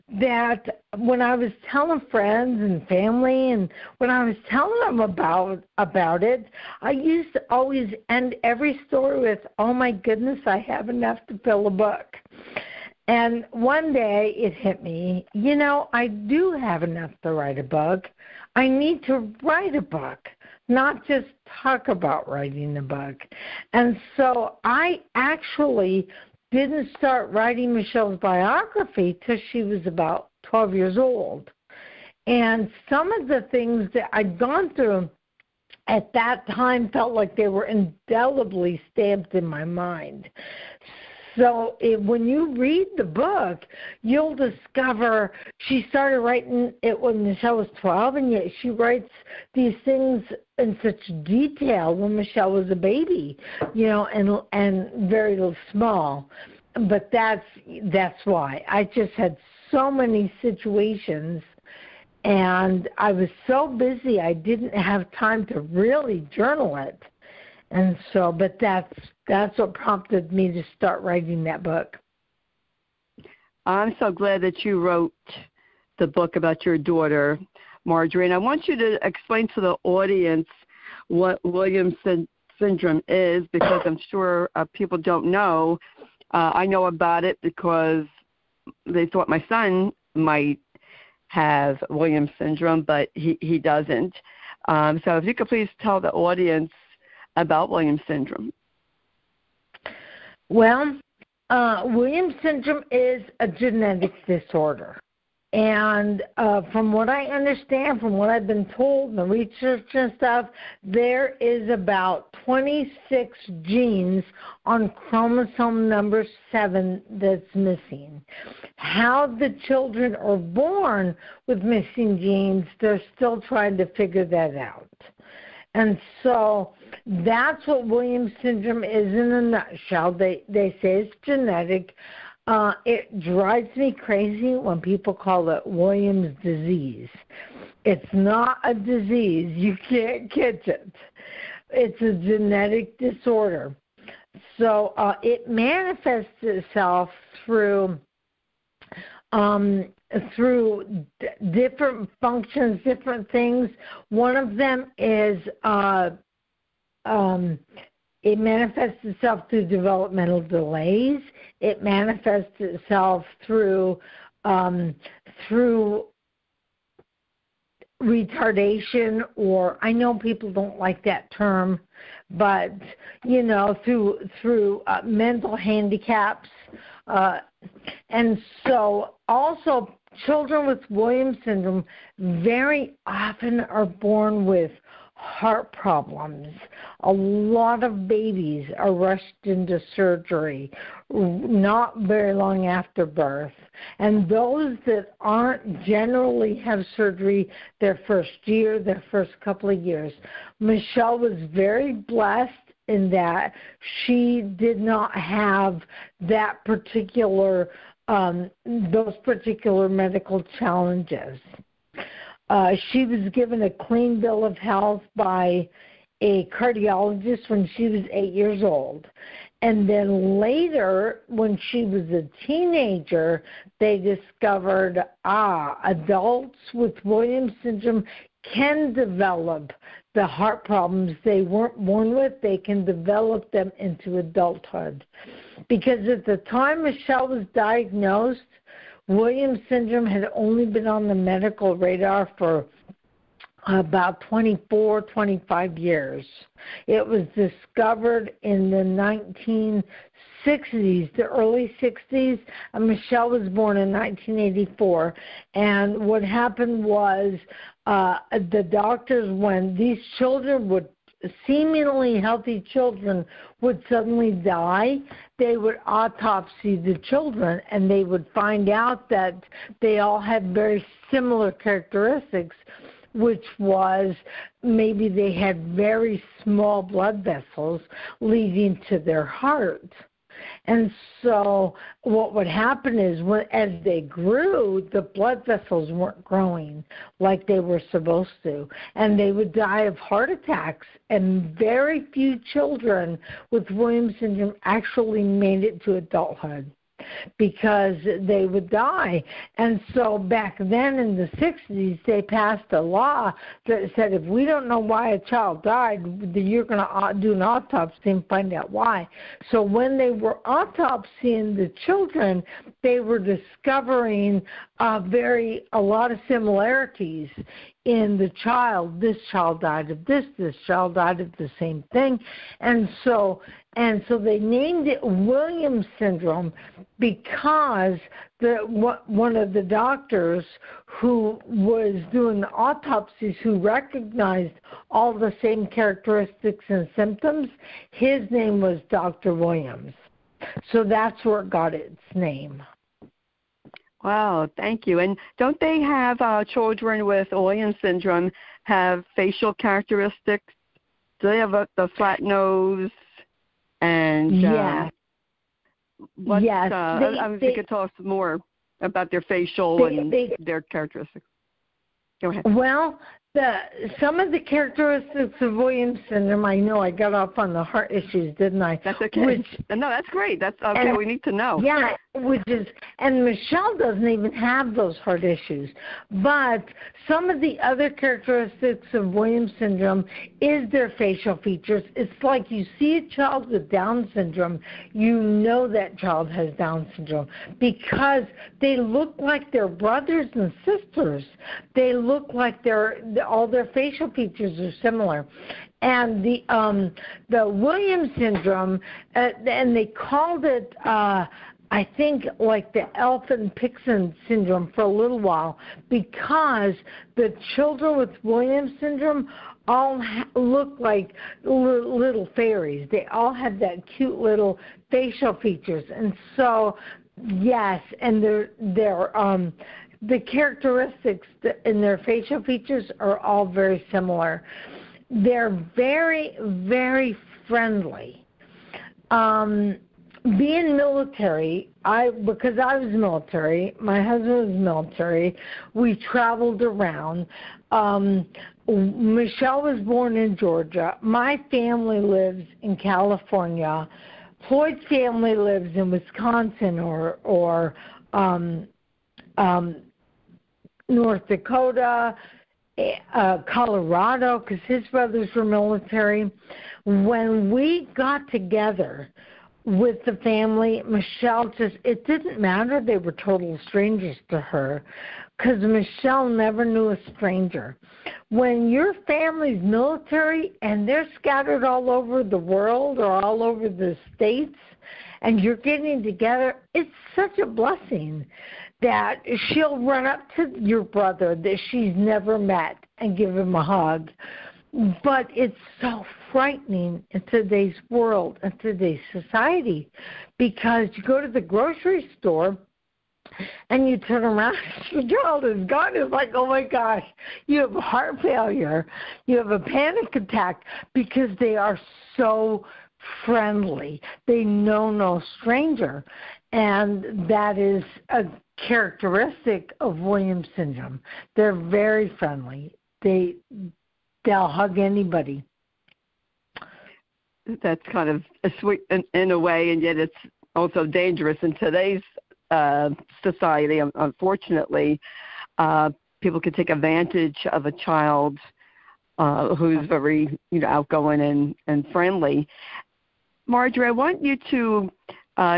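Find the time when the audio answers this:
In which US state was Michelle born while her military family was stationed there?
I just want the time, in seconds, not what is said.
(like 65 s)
440 s.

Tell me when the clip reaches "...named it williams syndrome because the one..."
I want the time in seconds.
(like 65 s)
324 s.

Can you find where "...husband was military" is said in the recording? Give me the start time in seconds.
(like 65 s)
434 s.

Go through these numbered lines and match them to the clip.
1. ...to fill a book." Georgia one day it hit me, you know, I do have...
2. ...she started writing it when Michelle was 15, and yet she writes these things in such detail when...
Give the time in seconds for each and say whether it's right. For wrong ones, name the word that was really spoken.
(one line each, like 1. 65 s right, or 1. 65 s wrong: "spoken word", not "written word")
1. 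11 s wrong: "And", not "Georgia"
2. 45 s wrong: "12", not "15".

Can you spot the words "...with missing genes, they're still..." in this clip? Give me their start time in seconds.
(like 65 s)
121 s.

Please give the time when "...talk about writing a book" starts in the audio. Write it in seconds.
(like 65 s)
21 s.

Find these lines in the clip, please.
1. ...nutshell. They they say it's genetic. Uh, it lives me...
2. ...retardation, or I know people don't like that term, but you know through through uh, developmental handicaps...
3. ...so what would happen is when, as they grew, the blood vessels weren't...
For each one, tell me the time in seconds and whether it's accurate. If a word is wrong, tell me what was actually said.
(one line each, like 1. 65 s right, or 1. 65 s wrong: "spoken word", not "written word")
1. 129 s wrong: "drives", not "lives"
2. 168 s wrong: "mental", not "developmental"
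3. 281 s right.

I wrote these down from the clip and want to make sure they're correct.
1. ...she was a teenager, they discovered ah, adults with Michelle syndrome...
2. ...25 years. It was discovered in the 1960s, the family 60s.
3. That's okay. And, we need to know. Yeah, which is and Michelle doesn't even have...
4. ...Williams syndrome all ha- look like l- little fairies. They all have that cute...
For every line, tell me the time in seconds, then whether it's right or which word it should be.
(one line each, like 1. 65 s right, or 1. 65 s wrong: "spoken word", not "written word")
1. 221 s wrong: "Williams", not "Michelle"
2. 245 s wrong: "early", not "family"
3. 370 s right
4. 408 s right.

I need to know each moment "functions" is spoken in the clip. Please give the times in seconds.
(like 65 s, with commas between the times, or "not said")
152 s.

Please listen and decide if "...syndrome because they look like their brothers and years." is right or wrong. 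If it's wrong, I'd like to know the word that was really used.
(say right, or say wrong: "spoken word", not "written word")
wrong: "sisters", not "years".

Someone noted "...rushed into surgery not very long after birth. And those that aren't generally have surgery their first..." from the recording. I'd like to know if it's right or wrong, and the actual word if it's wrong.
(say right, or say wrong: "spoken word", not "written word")
right.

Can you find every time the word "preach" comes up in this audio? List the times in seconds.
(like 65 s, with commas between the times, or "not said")
not said.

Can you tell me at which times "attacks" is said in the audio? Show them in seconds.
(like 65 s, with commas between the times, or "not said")
290 s, 500 s.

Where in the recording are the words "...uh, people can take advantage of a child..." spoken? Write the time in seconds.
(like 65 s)
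525 s.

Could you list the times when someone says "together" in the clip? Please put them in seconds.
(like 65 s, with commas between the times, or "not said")
458 s, 476 s.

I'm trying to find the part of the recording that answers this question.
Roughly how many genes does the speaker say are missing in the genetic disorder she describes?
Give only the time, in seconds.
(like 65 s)
111 s.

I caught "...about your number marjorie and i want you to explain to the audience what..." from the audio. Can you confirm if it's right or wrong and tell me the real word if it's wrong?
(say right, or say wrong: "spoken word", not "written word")
wrong: "daughter", not "number".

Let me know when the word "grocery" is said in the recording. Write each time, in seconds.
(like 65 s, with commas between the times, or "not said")
491 s.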